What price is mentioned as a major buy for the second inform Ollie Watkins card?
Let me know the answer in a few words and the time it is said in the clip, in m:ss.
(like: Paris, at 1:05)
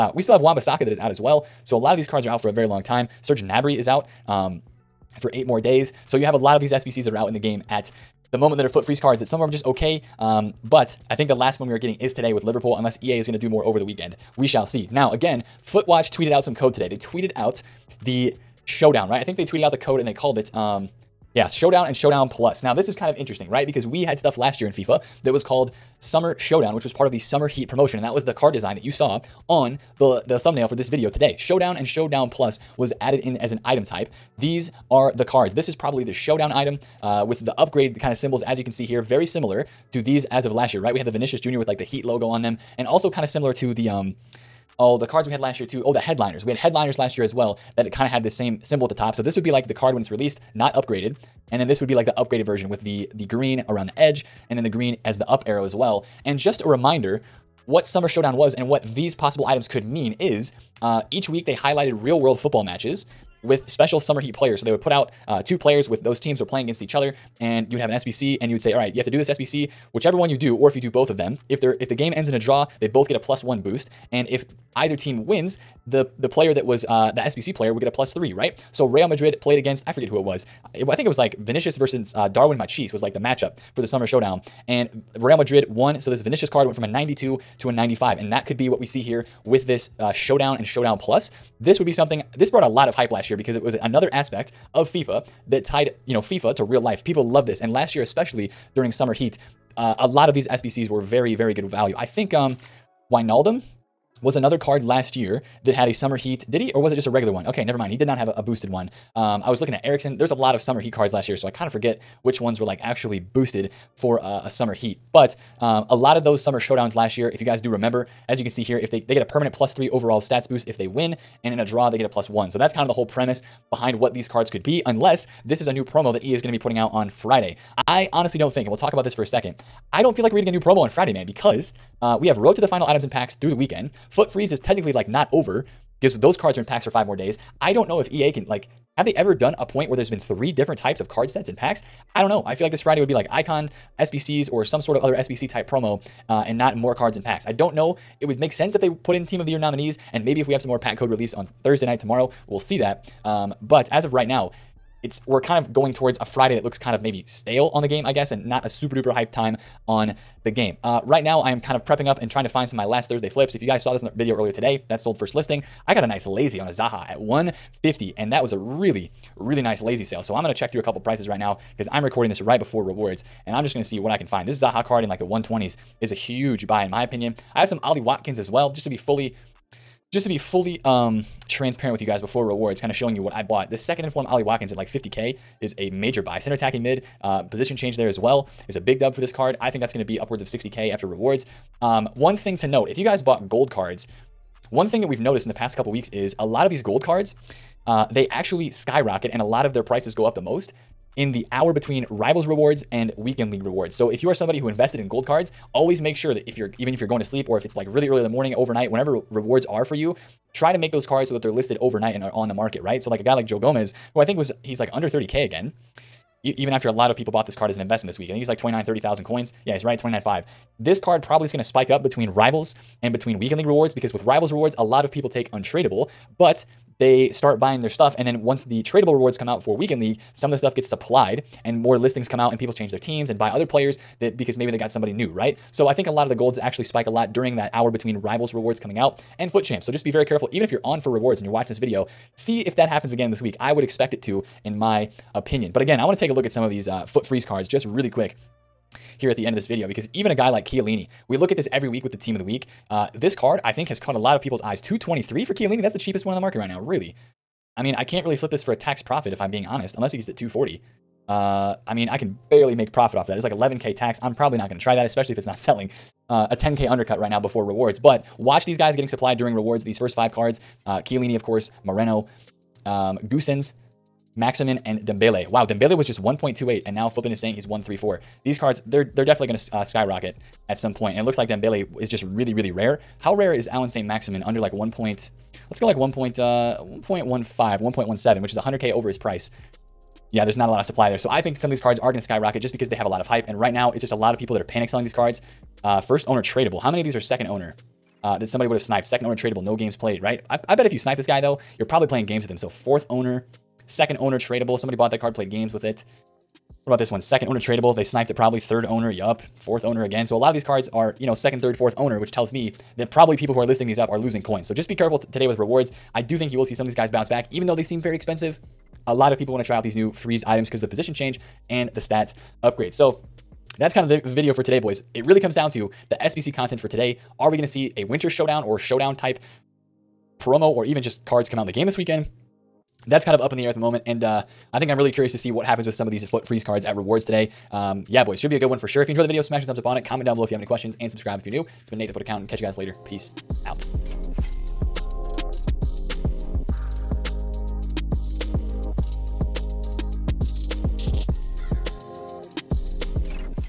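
50K, at 3:04.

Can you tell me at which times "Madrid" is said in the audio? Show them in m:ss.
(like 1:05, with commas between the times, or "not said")
1:19, 1:25.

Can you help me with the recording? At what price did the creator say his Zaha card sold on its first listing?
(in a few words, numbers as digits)
150.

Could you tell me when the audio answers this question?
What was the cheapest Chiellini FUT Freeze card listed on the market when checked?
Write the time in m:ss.
4:14.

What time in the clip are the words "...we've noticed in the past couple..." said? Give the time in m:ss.
3:15.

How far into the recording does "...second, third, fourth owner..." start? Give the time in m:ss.
5:11.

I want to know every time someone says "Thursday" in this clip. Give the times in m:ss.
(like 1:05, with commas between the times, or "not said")
2:31, 2:43.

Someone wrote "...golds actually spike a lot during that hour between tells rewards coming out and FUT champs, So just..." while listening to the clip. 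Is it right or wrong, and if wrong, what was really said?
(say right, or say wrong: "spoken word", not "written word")
wrong: "rivals", not "tells".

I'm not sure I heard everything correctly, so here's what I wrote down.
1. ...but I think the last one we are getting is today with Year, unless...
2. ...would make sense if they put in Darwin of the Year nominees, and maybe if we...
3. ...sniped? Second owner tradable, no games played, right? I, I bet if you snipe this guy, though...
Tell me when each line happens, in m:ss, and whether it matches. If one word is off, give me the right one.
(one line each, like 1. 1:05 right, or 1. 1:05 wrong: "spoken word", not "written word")
1. 0:10 wrong: "Liverpool", not "Year"
2. 2:28 wrong: "Team", not "Darwin"
3. 4:58 right.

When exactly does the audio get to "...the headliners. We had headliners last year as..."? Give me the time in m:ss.
0:45.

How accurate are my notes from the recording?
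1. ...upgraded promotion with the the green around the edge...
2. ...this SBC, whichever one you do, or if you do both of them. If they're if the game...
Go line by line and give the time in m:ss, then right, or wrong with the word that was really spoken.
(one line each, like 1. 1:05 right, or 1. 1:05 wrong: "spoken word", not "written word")
1. 0:52 wrong: "version", not "promotion"
2. 1:09 right.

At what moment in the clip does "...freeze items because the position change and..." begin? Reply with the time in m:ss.
5:20.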